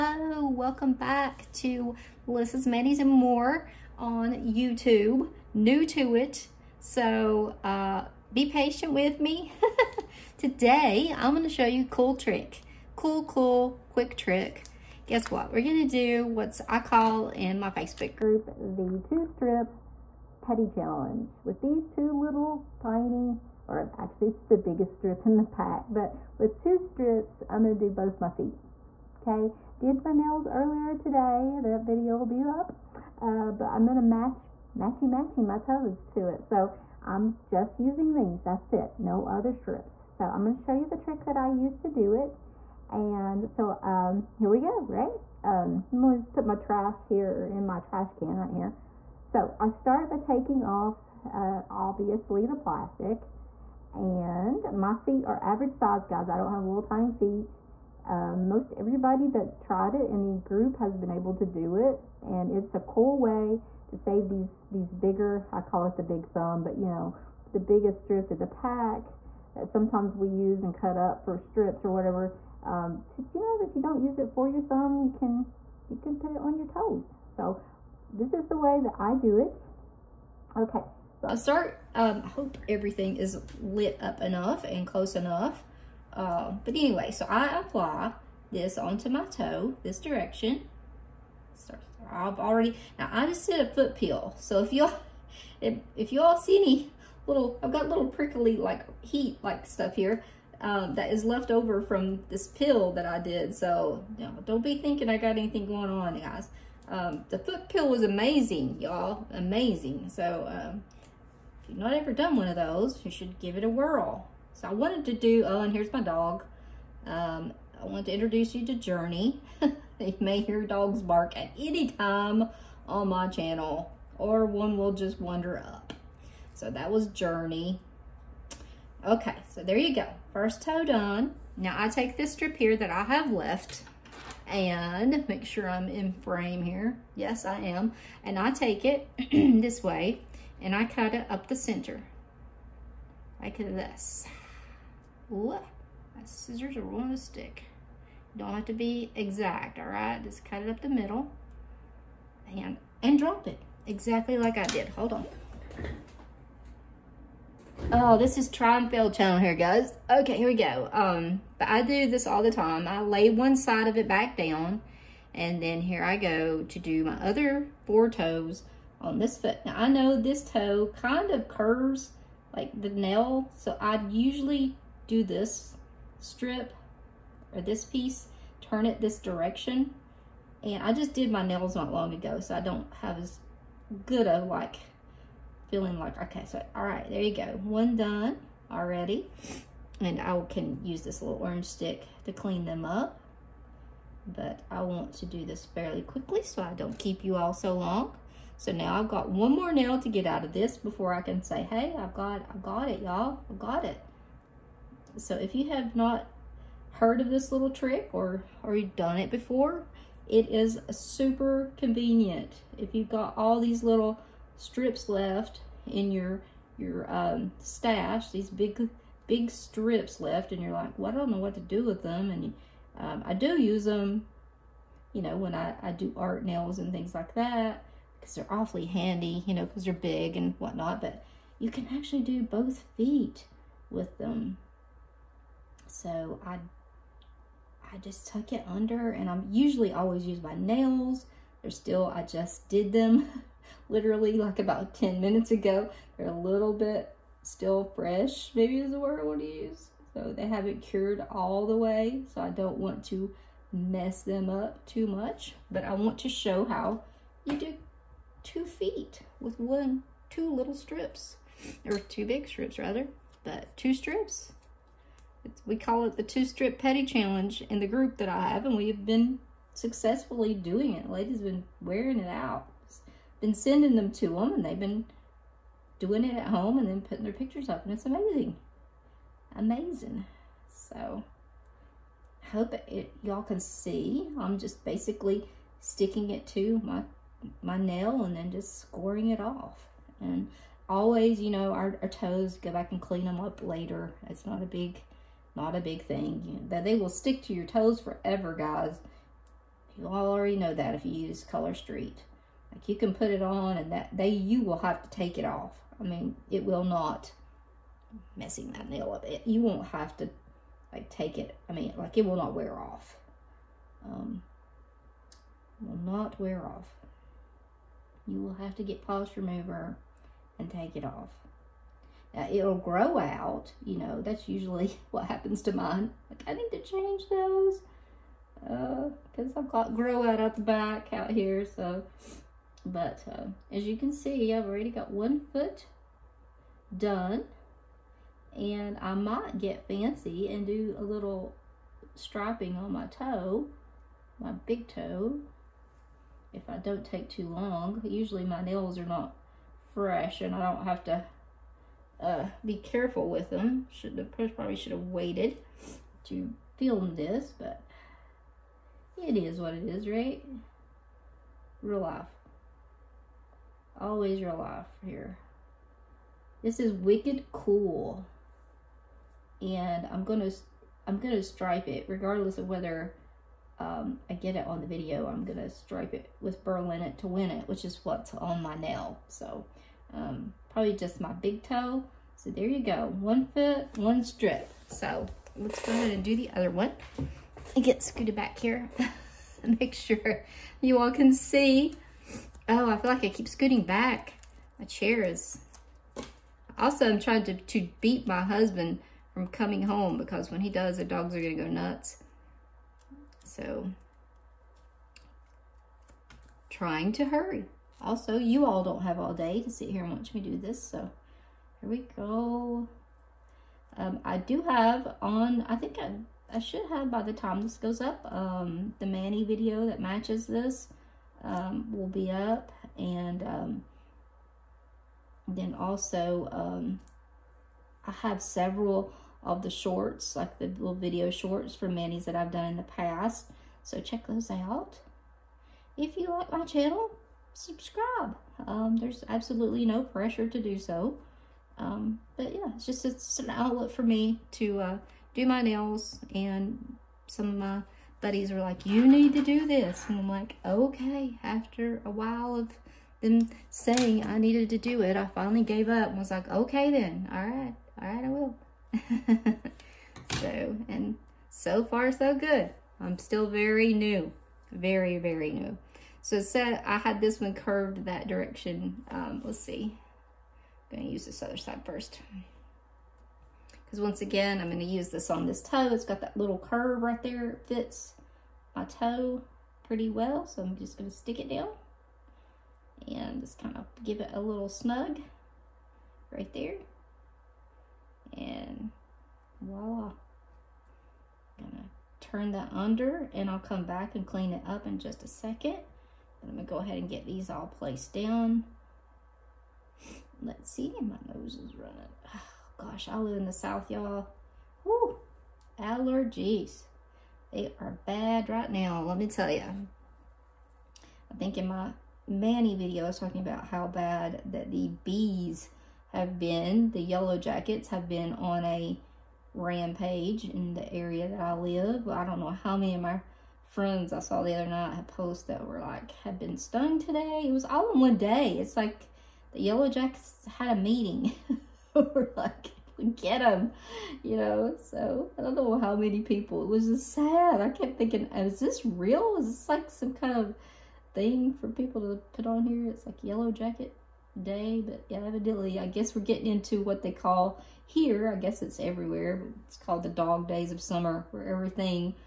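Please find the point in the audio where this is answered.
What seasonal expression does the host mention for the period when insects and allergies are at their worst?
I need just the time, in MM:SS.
09:10.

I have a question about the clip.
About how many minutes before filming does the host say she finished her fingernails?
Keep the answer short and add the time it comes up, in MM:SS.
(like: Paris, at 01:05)
10, at 04:04.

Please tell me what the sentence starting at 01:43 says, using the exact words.
So you know, don't be thinking I got anything going on, guys.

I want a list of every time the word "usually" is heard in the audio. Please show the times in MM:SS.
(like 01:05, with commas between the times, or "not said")
02:54, 03:59, 05:24, 05:48.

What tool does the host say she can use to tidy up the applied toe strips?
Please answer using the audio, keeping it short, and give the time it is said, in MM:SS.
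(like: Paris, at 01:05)
orange stick, at 03:11.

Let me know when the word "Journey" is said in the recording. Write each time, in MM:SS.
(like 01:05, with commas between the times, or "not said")
01:58, 02:07.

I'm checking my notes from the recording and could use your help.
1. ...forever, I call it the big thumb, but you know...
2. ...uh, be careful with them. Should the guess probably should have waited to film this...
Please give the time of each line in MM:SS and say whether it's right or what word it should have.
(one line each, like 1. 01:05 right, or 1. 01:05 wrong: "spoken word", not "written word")
1. 01:04 wrong: "bigger", not "forever"
2. 05:52 wrong: "press", not "guess".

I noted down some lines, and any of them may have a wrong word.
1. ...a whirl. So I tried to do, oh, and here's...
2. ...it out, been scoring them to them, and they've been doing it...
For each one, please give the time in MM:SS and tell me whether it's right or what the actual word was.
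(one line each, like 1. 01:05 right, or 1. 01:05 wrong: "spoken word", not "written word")
1. 01:53 wrong: "wanted", not "tried"
2. 04:32 wrong: "sending", not "scoring".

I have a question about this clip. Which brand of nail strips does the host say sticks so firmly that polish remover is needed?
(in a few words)
Color Street.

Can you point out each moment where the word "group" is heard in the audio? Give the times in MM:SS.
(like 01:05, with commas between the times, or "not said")
00:18, 01:00, 04:27.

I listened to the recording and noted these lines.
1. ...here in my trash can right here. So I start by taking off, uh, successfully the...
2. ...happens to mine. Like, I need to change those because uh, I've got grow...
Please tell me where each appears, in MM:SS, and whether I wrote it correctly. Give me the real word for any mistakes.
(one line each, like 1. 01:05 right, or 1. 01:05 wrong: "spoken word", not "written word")
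1. 00:47 wrong: "obviously", not "successfully"
2. 05:25 right.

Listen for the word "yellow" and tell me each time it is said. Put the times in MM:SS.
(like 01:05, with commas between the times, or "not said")
08:37, 08:49, 09:03.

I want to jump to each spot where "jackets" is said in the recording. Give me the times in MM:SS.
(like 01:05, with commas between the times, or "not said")
08:37, 08:49, 09:03.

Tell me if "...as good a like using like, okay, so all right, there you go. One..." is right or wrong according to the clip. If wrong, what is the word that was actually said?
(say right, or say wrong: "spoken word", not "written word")
wrong: "feeling", not "using".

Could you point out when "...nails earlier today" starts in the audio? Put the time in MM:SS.
00:30.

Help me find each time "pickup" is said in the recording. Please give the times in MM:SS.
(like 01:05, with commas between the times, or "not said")
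not said.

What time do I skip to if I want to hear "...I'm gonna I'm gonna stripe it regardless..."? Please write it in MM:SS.
06:10.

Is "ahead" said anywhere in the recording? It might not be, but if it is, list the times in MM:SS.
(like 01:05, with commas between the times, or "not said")
06:25, 08:16.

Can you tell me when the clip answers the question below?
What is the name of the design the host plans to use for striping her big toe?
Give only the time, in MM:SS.
06:16.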